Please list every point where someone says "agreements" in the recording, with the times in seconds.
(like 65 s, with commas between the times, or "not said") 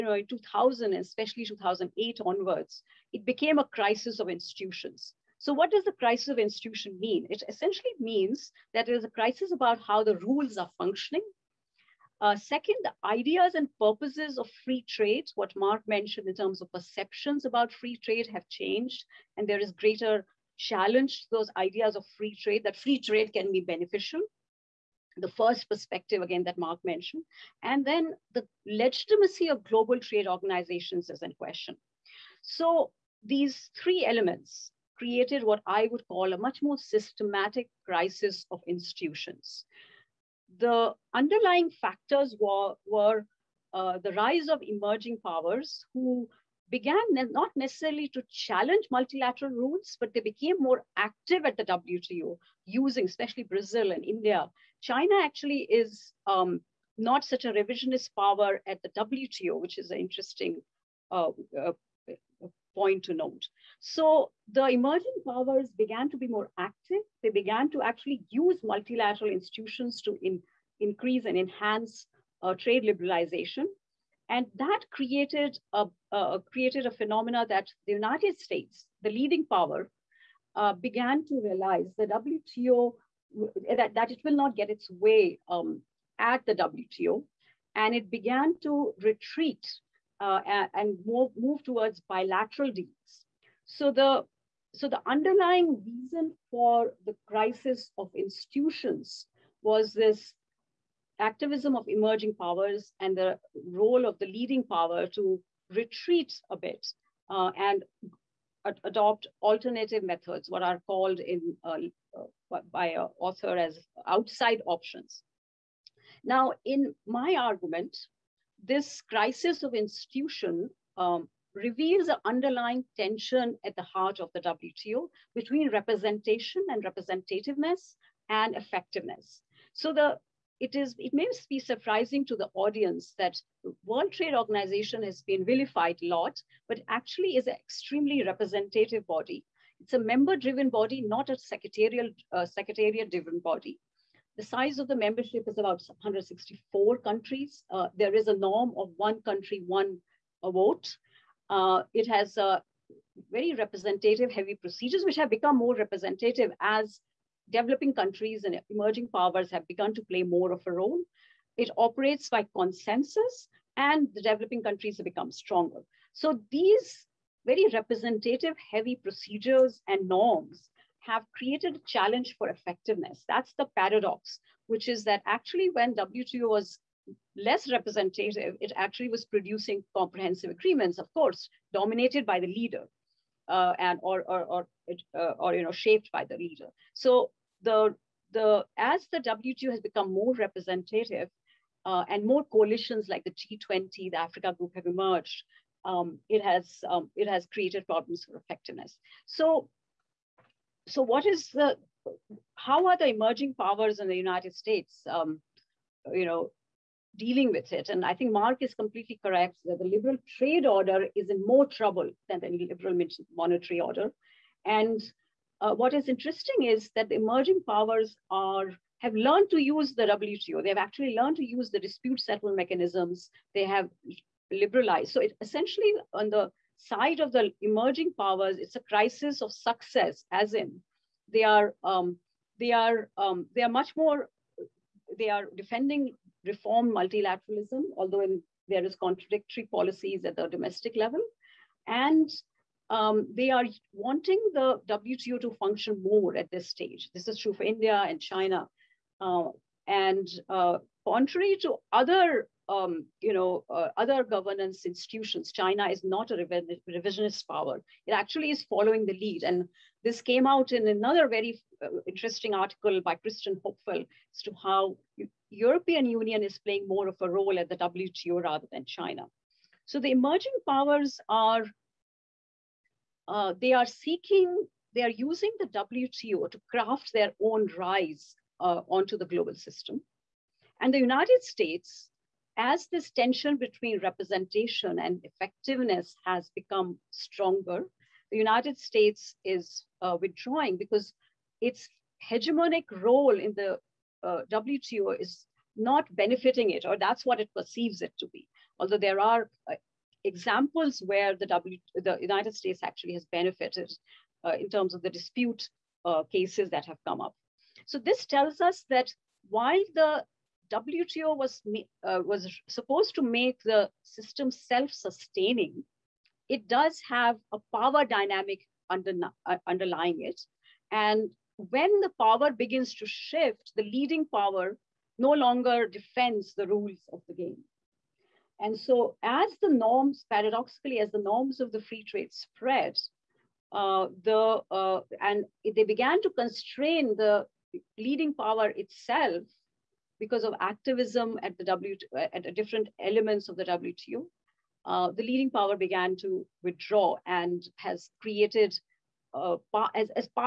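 180 s.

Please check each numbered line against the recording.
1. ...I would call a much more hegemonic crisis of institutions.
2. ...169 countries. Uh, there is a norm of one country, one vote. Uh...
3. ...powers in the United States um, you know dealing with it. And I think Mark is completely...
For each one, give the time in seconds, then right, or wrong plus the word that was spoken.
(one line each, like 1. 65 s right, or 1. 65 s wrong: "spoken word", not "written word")
1. 35 s wrong: "systematic", not "hegemonic"
2. 145 s wrong: "164", not "169"
3. 203 s right.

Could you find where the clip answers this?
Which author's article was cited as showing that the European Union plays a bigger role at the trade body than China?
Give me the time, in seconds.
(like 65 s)
263 s.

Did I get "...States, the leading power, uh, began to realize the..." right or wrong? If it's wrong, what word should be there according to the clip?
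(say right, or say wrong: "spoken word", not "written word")
right.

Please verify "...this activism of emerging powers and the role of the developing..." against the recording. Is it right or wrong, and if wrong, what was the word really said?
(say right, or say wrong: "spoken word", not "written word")
wrong: "leading", not "developing".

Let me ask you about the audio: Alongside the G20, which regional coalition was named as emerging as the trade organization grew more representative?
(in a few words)
Africa Group.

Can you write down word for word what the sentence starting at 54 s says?
China actually is um, not such a revisionist power at the WTO, which is an interesting uh, uh, point to note.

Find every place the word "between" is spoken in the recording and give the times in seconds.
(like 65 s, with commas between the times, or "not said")
125 s, 283 s.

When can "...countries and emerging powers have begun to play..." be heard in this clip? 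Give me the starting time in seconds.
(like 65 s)
157 s.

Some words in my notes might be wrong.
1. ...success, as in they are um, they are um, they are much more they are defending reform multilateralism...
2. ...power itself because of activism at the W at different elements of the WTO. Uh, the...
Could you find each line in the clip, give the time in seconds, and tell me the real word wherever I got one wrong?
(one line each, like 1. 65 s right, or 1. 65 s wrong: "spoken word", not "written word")
1. 229 s right
2. 338 s right.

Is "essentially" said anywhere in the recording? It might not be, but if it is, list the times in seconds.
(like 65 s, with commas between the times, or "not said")
7 s, 225 s.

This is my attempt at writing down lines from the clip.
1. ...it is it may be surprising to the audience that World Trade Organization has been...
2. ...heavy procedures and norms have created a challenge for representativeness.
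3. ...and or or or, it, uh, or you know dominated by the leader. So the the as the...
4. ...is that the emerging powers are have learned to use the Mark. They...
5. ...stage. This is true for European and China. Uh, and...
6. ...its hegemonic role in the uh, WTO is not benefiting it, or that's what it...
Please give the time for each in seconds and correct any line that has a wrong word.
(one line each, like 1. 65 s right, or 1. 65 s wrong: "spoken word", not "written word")
1. 130 s right
2. 168 s wrong: "effectiveness", not "representativeness"
3. 183 s wrong: "shaped", not "dominated"
4. 216 s wrong: "WTO", not "Mark"
5. 246 s wrong: "India", not "European"
6. 291 s right.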